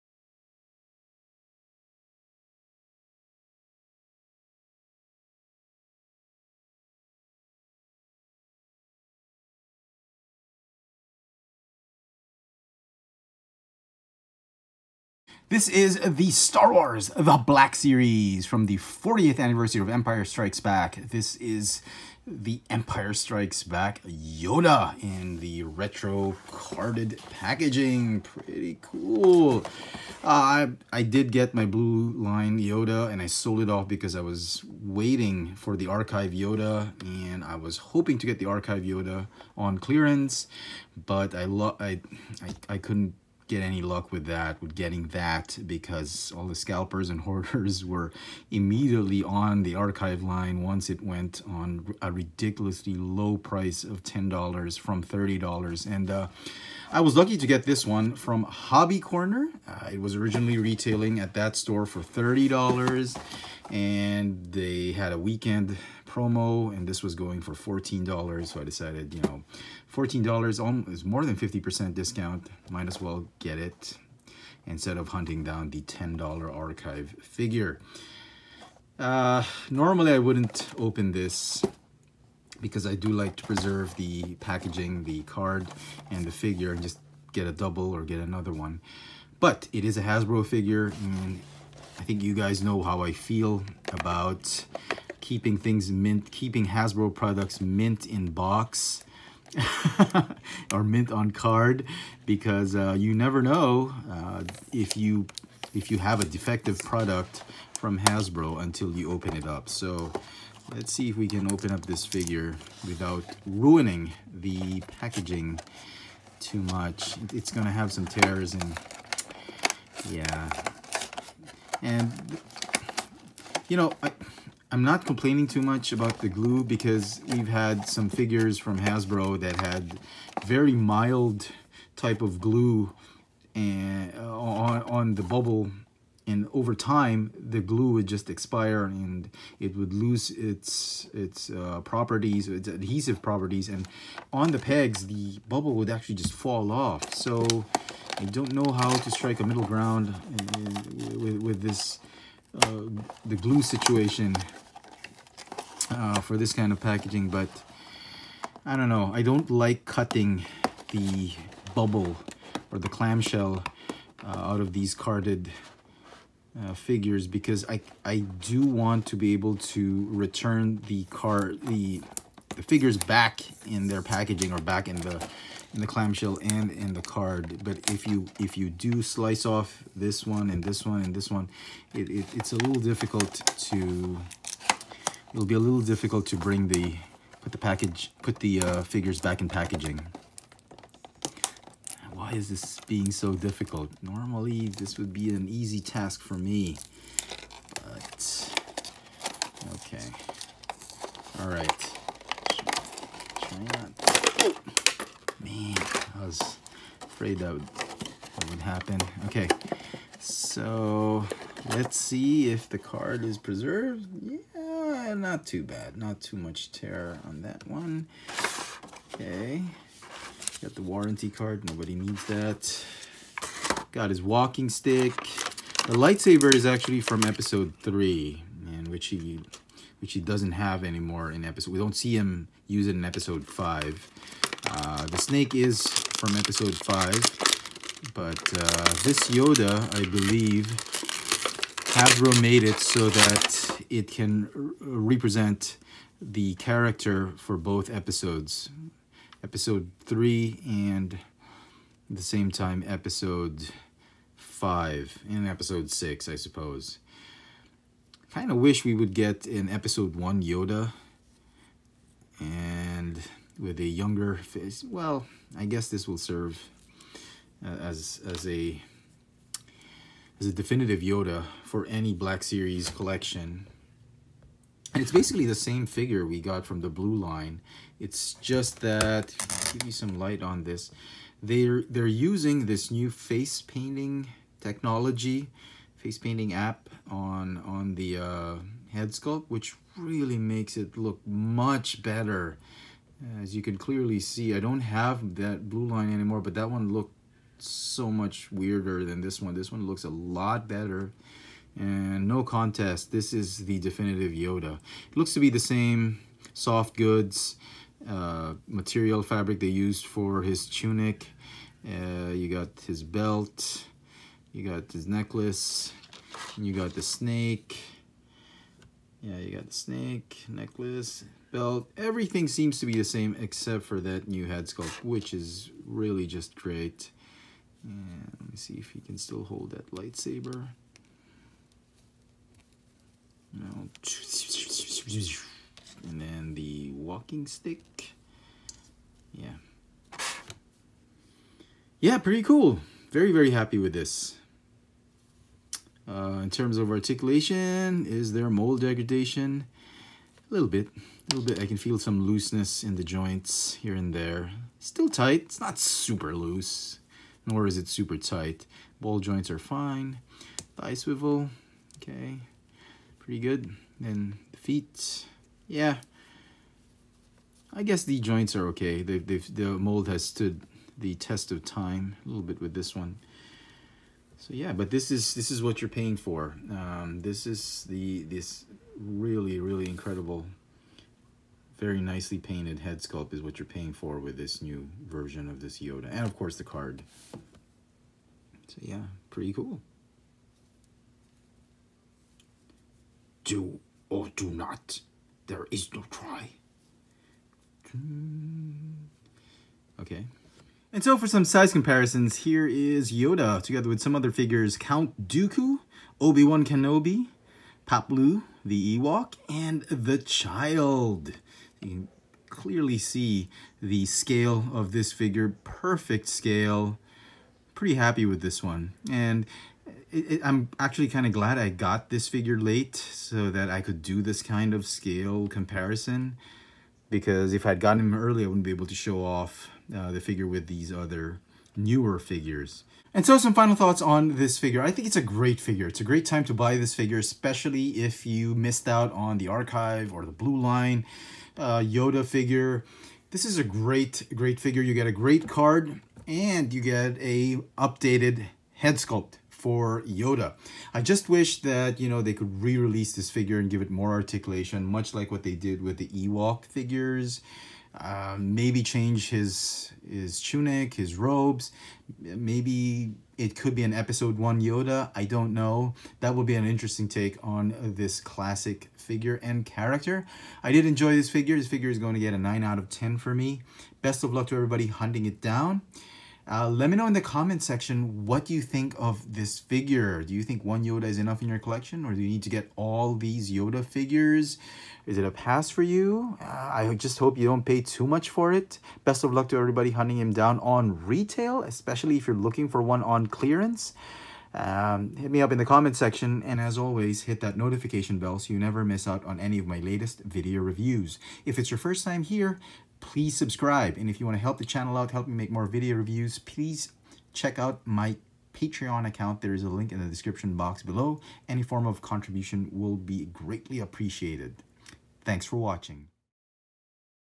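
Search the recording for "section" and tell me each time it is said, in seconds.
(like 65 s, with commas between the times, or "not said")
477 s, 495 s.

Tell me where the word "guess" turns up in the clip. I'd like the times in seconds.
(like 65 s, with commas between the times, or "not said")
265 s, 367 s.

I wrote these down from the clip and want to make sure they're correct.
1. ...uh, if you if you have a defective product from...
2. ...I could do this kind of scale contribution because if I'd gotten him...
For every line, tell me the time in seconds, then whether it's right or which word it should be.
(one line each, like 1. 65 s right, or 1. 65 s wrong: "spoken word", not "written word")
1. 104 s right
2. 423 s wrong: "comparison", not "contribution".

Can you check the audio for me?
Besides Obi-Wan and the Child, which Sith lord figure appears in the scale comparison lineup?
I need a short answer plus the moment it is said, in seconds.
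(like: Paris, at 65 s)
Count Dooku, at 404 s.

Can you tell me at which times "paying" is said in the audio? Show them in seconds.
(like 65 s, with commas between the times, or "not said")
375 s, 383 s.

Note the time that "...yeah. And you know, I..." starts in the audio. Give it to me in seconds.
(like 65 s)
120 s.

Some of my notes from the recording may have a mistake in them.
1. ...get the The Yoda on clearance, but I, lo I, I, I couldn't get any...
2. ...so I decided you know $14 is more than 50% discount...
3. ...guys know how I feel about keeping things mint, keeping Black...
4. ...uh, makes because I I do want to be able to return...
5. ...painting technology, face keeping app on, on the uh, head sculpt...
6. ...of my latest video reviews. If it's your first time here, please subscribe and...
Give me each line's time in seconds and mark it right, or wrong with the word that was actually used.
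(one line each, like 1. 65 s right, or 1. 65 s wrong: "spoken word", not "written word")
1. 38 s wrong: "Archive", not "The"
2. 68 s right
3. 92 s wrong: "Hasbro", not "Black"
4. 166 s wrong: "figures", not "makes"
5. 283 s wrong: "painting", not "keeping"
6. 499 s right.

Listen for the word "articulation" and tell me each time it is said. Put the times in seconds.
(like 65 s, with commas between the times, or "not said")
346 s, 454 s.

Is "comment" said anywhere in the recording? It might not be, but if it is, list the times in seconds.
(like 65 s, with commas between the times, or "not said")
477 s, 495 s.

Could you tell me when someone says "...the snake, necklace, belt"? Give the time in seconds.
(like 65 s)
319 s.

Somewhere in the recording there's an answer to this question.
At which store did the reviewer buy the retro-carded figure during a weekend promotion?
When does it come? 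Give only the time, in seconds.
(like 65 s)
58 s.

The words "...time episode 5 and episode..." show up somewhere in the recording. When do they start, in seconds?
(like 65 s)
252 s.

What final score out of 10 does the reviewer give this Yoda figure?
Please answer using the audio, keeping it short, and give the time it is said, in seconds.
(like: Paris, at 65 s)
9, at 472 s.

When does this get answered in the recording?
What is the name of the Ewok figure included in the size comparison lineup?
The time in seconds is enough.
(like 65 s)
407 s.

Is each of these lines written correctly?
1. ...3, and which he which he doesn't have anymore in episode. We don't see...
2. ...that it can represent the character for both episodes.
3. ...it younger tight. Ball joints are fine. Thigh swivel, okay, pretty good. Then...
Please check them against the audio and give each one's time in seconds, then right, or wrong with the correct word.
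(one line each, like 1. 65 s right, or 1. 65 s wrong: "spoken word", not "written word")
1. 227 s right
2. 243 s right
3. 357 s wrong: "super", not "younger".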